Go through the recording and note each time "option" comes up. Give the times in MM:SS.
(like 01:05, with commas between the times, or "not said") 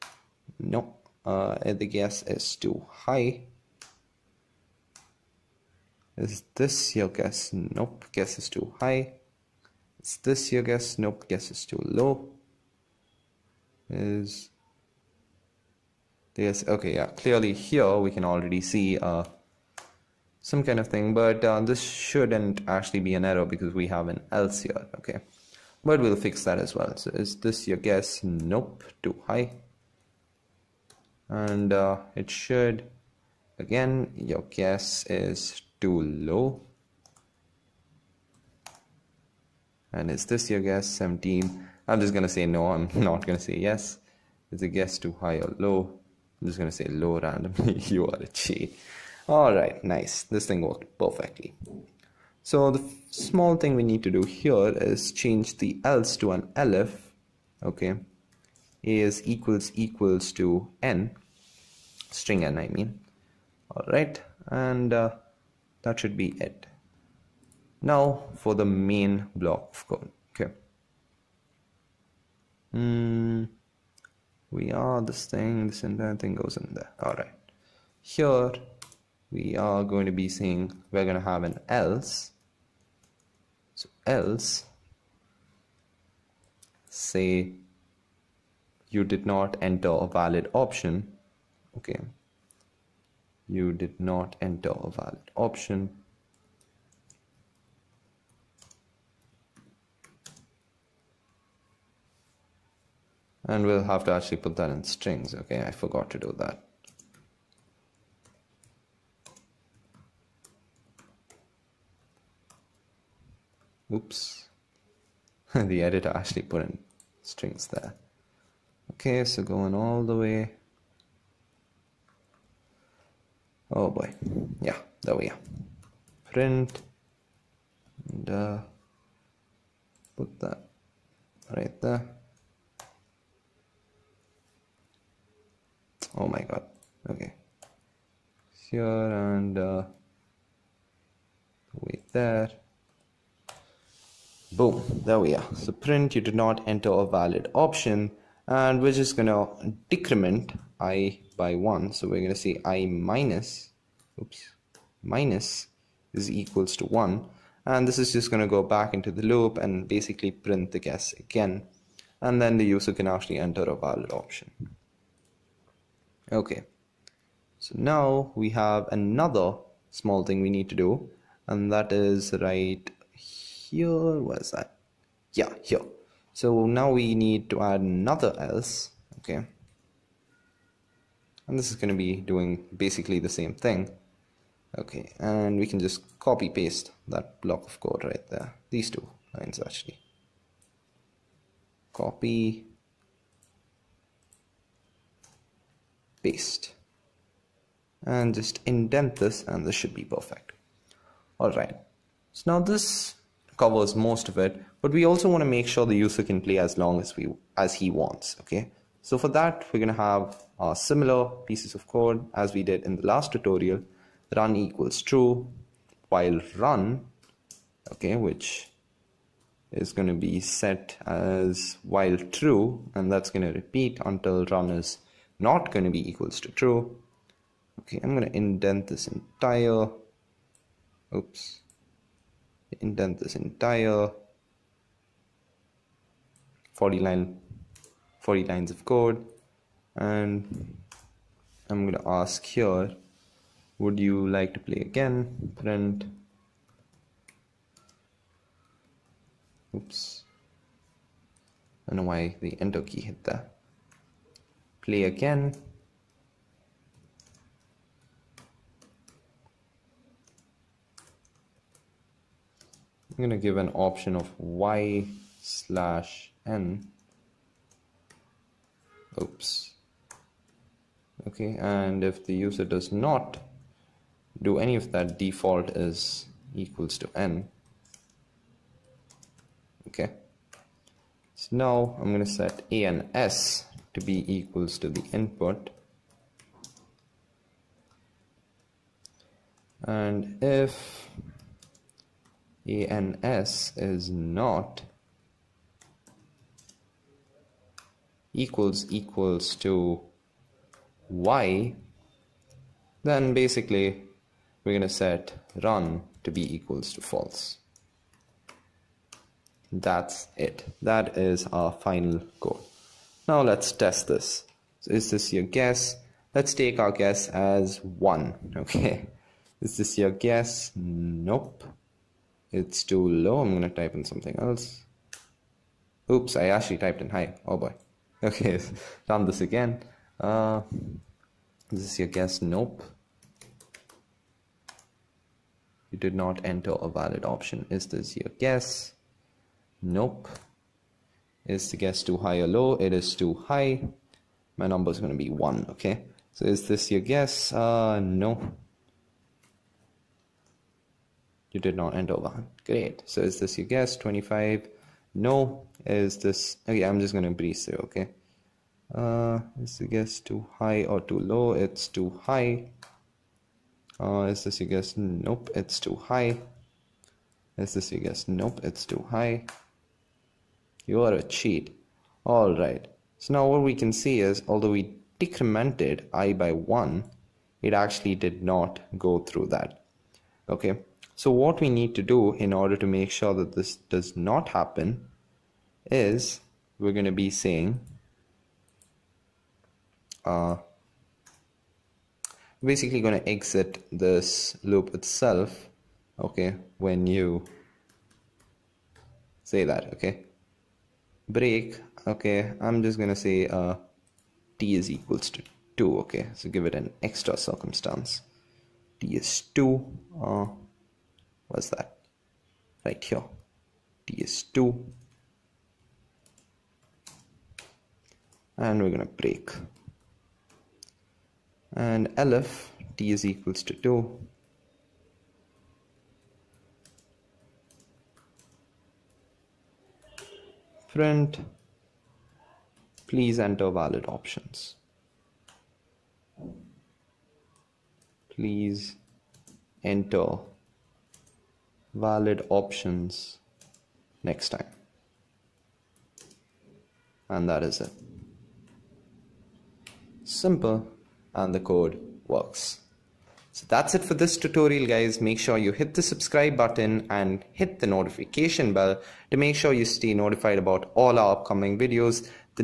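01:30, 01:35, 02:27, 02:44, 04:23, 05:37, 07:14, 07:22.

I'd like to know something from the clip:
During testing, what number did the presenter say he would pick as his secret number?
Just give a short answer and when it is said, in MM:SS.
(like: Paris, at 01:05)
1, at 05:44.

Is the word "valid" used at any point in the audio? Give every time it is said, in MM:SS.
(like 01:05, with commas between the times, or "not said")
01:30, 01:34, 02:27, 02:43, 05:36, 07:13, 07:21.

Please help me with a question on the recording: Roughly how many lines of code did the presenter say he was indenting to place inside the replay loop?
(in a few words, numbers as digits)
40.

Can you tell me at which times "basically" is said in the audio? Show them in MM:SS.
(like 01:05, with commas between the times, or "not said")
02:39, 03:02, 05:03, 06:32.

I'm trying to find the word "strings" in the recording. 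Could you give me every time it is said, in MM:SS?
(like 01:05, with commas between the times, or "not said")
01:02, 01:44, 01:57.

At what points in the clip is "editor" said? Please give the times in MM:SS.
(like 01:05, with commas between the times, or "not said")
01:55.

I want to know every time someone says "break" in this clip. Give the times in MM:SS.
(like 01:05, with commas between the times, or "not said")
06:41, 06:59.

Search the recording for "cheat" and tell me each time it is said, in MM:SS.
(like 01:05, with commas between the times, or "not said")
00:48, 06:11.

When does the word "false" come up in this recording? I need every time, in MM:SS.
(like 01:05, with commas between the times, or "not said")
05:07.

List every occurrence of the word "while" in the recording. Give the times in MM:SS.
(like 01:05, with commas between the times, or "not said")
03:36, 03:41.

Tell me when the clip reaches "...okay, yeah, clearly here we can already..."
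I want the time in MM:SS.
00:16.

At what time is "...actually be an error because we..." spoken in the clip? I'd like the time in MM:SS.
00:22.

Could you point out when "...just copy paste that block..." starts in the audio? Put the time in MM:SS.
03:05.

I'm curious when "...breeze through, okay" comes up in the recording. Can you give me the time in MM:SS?
05:57.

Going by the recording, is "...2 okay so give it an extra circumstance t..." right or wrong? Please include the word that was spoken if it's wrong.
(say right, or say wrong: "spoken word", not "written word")
right.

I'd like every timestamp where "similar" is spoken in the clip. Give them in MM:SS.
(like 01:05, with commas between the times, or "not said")
03:30.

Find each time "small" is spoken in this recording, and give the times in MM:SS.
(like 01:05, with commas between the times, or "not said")
00:53, 02:49.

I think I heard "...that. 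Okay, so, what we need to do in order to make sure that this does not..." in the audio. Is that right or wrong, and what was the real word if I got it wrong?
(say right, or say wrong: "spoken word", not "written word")
right.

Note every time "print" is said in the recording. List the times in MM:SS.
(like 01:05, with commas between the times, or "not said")
02:06, 02:25, 02:40, 04:05, 07:10.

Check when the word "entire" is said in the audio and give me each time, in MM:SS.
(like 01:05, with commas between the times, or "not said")
01:15, 03:49, 03:53.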